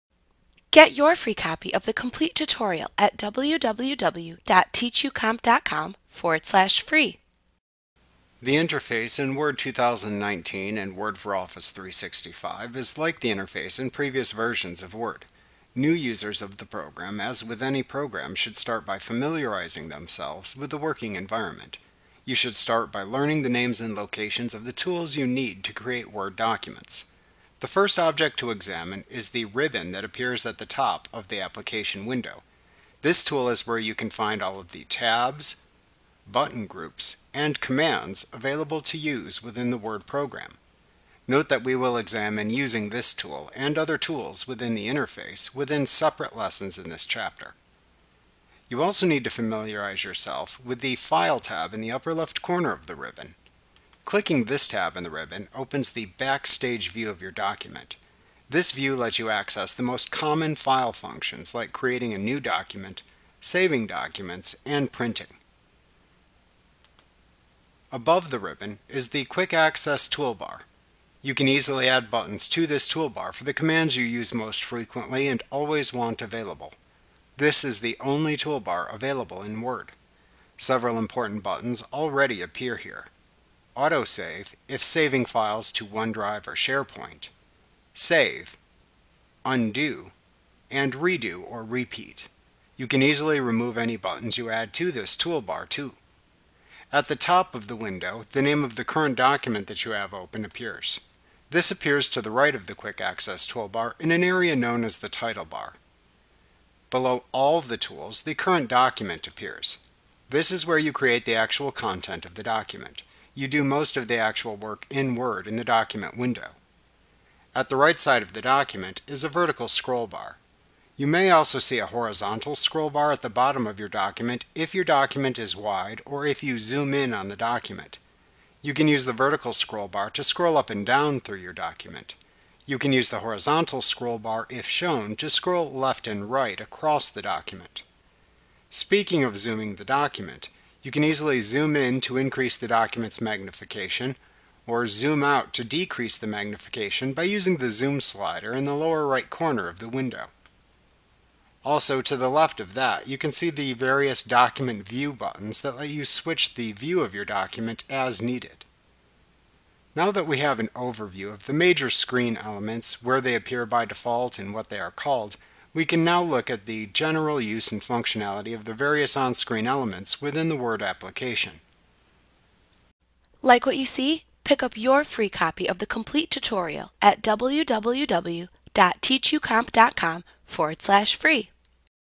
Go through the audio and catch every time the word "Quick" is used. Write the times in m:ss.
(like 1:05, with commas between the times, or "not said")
1:09, 1:42.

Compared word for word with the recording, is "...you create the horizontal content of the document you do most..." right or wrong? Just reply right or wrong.
wrong.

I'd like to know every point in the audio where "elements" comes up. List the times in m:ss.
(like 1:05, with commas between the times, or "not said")
2:42, 2:49.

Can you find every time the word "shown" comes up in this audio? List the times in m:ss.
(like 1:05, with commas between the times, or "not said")
2:14.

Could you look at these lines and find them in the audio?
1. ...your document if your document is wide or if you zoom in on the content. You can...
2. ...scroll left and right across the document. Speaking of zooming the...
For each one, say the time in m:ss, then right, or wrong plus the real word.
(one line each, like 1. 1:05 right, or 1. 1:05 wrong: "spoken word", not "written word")
1. 2:03 wrong: "document", not "content"
2. 2:15 right.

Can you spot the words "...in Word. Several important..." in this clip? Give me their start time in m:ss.
1:19.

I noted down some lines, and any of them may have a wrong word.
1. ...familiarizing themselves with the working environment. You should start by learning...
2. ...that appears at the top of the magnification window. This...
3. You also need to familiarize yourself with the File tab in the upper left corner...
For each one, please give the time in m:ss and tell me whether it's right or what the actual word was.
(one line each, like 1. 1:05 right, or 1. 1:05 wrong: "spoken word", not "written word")
1. 0:18 right
2. 0:29 wrong: "application", not "magnification"
3. 0:48 right.